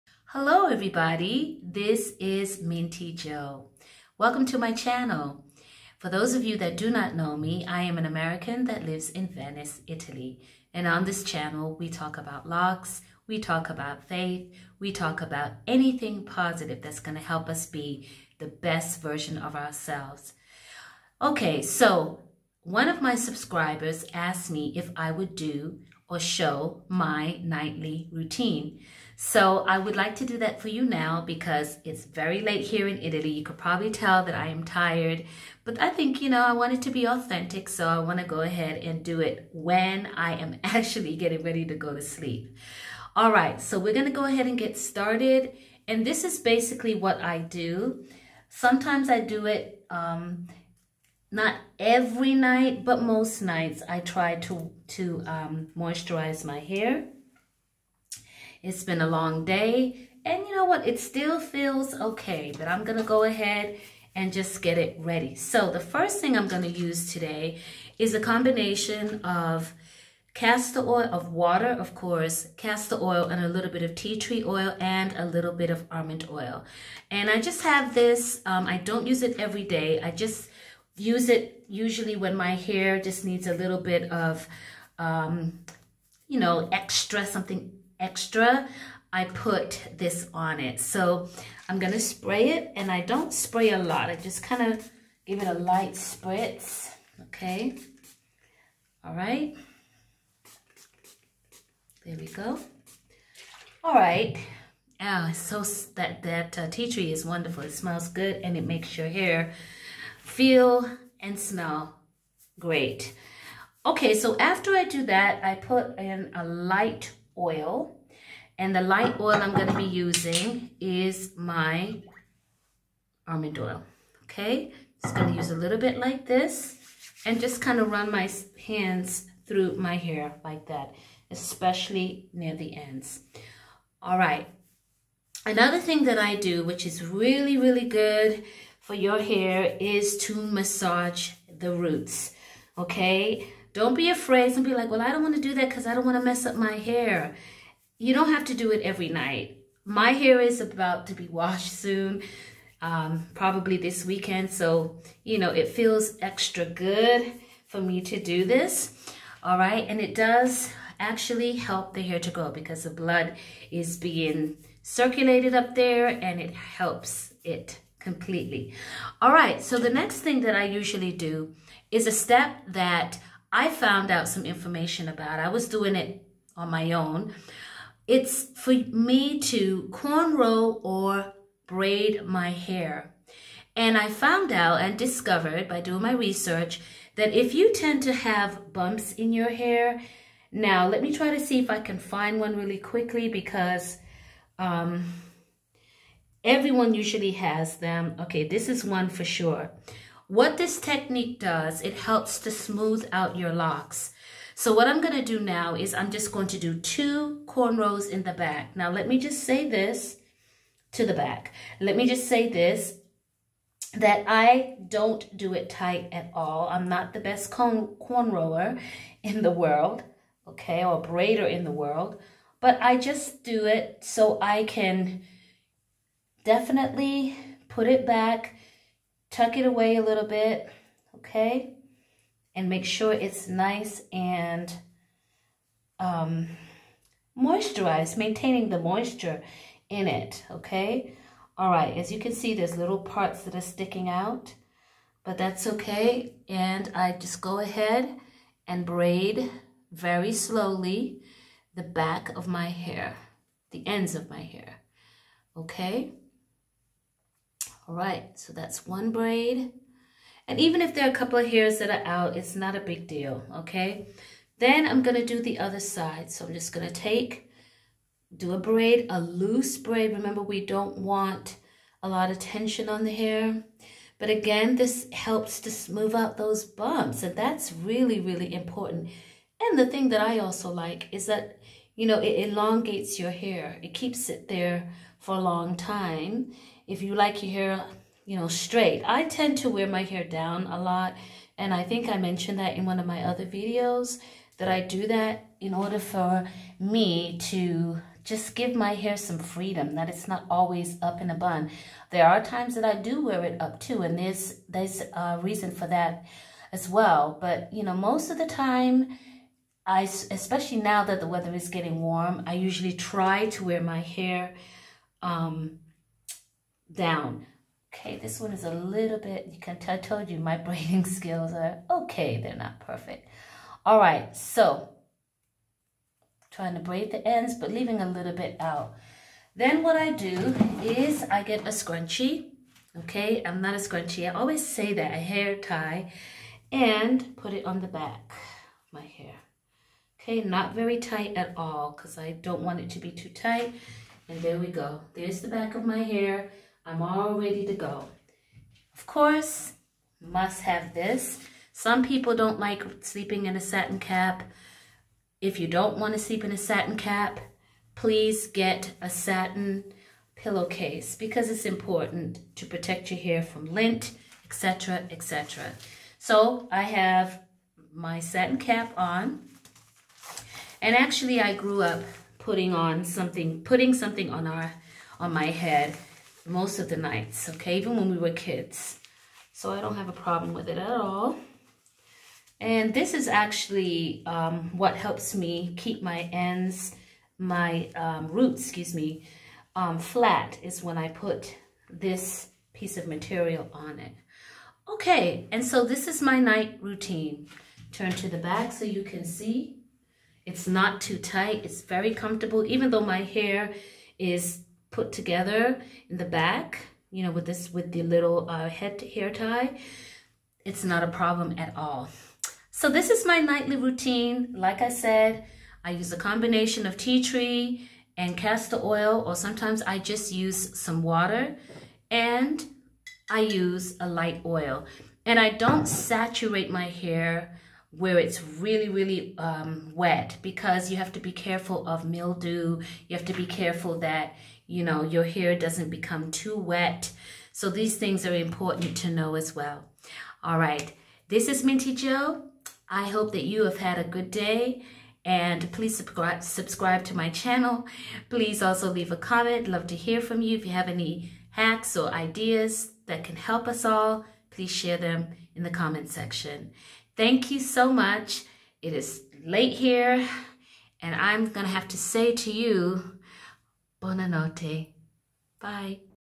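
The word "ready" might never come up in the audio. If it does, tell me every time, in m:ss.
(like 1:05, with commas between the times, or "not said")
0:41, 1:04, 5:47.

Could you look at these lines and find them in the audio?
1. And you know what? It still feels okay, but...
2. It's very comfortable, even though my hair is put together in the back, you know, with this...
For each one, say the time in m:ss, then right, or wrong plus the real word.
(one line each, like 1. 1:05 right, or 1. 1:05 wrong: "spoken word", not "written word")
1. 1:00 right
2. 6:41 right.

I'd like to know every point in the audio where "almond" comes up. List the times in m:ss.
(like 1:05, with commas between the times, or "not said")
1:15, 2:03.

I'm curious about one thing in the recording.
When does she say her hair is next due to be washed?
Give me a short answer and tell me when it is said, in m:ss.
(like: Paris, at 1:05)
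This weekend, at 2:33.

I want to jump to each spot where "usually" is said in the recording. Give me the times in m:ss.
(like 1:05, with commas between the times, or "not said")
1:21, 2:50, 3:16, 5:12.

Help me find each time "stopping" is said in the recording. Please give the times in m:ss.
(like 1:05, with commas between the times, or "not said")
not said.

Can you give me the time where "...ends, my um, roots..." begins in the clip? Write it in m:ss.
6:26.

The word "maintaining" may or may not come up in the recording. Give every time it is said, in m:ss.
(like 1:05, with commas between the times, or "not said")
3:58.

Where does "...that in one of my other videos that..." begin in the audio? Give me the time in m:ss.
4:52.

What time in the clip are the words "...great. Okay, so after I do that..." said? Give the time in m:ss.
1:52.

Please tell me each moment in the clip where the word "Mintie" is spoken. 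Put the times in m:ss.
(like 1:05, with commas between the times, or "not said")
0:02, 7:21.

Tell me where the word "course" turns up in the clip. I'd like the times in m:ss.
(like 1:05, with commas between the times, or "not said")
1:11, 5:49.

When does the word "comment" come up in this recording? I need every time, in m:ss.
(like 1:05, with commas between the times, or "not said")
7:29, 7:35.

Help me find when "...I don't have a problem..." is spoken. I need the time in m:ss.
6:19.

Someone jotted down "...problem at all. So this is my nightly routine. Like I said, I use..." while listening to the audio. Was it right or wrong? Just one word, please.
right.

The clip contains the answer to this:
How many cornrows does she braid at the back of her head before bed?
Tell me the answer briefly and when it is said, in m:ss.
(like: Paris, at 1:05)
2, at 3:26.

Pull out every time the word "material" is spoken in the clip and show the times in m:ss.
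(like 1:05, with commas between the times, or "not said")
6:33.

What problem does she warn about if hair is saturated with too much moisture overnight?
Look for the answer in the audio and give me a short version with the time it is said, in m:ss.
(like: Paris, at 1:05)
Mildew, at 7:12.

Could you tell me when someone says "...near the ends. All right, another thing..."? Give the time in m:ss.
2:12.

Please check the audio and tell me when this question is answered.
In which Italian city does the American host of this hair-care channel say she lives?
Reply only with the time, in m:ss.
0:09.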